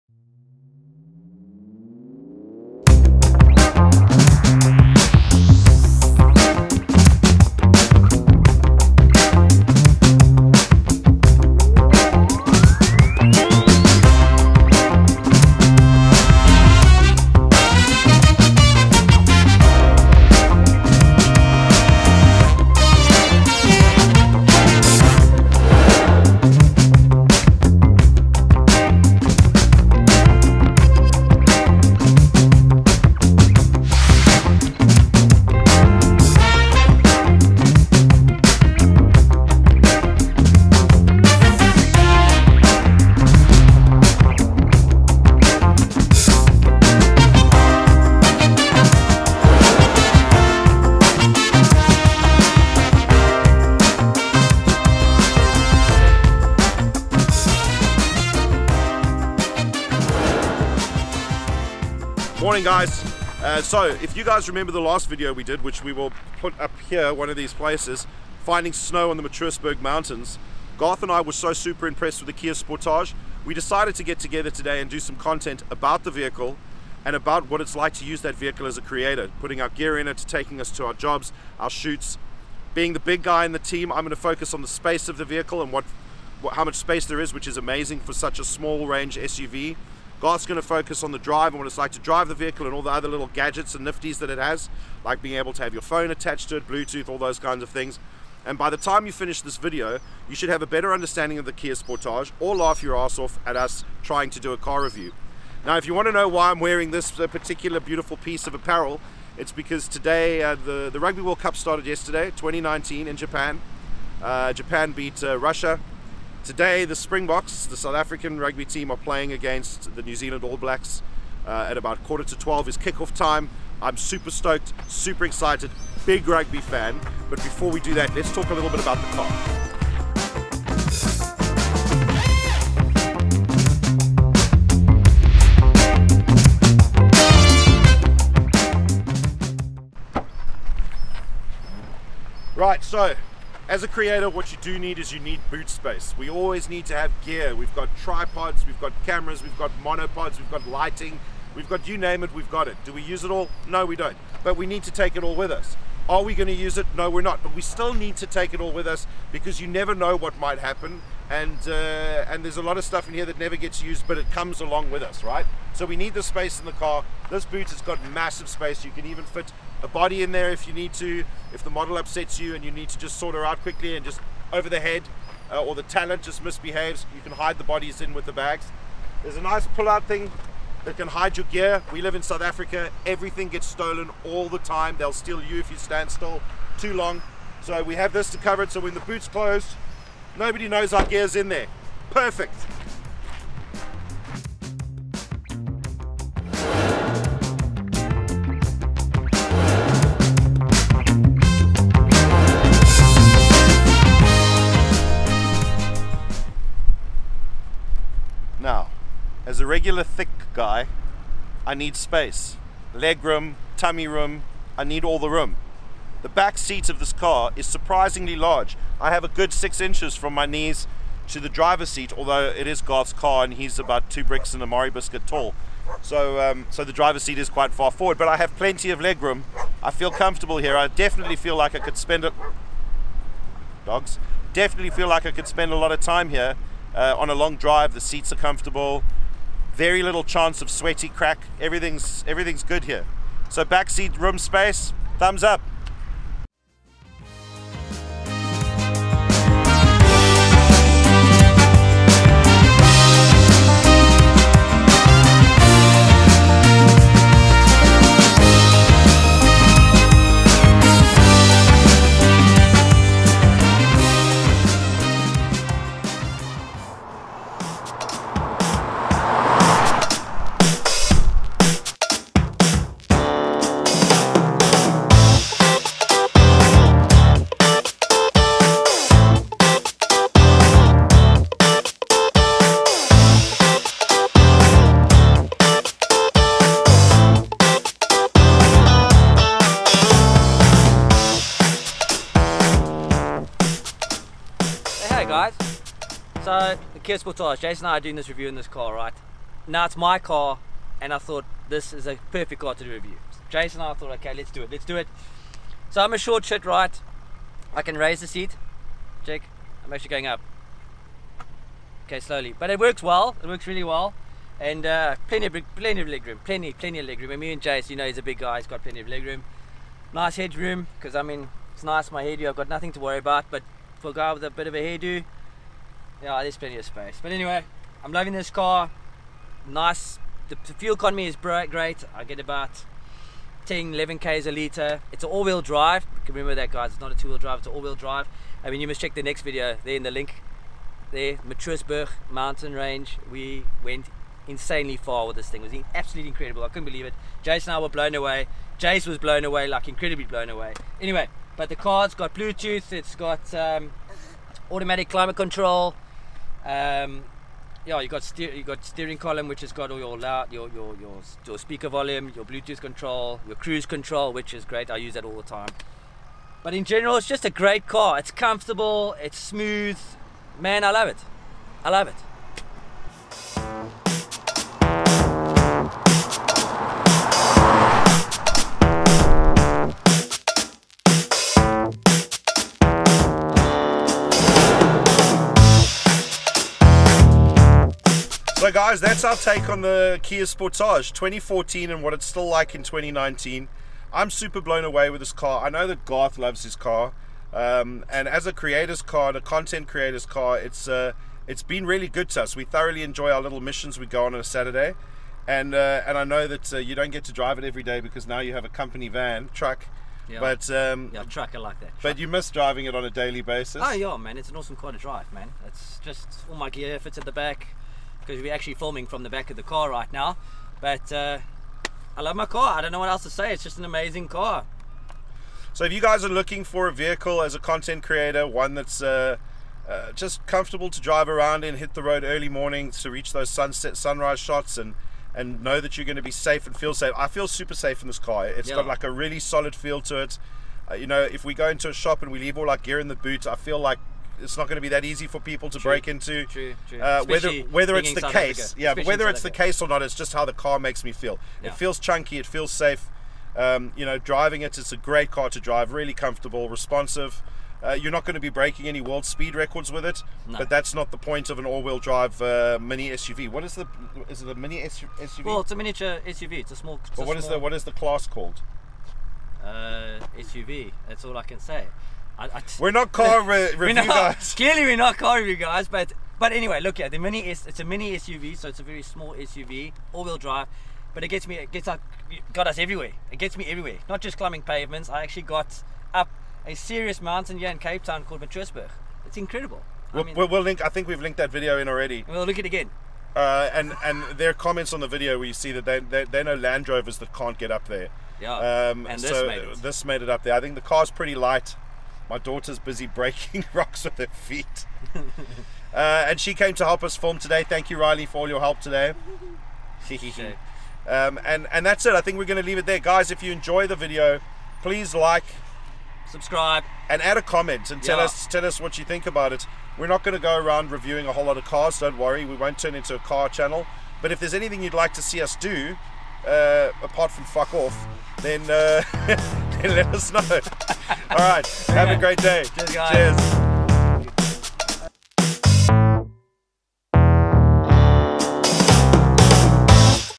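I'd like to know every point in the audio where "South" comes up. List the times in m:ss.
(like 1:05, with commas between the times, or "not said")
1:57, 3:02.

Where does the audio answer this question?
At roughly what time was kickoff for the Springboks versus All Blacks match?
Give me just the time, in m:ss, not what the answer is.
2:02.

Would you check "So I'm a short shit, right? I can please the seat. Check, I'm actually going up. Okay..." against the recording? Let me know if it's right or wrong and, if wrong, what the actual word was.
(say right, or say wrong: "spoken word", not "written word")
wrong: "raise", not "please".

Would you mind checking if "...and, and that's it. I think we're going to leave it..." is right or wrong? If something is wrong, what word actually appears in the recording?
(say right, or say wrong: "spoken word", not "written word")
right.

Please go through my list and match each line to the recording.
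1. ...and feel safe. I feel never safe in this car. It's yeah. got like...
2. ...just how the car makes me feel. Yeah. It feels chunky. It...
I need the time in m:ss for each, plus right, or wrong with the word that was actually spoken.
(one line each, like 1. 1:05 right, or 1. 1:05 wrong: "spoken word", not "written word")
1. 7:16 wrong: "super", not "never"
2. 7:30 right.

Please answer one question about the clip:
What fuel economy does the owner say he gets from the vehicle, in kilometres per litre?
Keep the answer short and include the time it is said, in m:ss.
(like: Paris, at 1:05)
10 to 11 km per litre, at 5:33.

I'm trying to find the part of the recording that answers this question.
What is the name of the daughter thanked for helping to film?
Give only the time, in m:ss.
8:27.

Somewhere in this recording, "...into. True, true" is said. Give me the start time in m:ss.
7:26.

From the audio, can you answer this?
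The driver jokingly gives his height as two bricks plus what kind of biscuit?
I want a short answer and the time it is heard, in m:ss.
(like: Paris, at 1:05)
Marie biscuit, at 3:44.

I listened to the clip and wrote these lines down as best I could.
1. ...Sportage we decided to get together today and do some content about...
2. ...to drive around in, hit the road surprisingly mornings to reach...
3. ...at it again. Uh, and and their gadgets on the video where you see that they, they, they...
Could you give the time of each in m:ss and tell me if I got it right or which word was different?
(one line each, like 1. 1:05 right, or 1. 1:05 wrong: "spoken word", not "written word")
1. 1:12 right
2. 7:10 wrong: "early", not "surprisingly"
3. 8:12 wrong: "comments", not "gadgets".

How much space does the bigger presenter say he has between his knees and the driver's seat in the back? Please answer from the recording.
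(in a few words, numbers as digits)
6 inches.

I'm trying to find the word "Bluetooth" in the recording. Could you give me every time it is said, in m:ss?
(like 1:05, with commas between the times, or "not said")
1:36, 5:52, 6:02.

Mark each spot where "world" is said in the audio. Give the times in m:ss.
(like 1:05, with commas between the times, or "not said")
1:51, 7:39.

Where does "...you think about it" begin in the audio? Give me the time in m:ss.
8:38.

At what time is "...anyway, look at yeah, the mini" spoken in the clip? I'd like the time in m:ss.
7:56.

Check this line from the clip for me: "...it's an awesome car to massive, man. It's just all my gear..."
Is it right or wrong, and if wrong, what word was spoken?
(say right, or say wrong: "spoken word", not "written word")
wrong: "drive", not "massive".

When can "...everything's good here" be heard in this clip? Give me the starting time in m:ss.
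4:02.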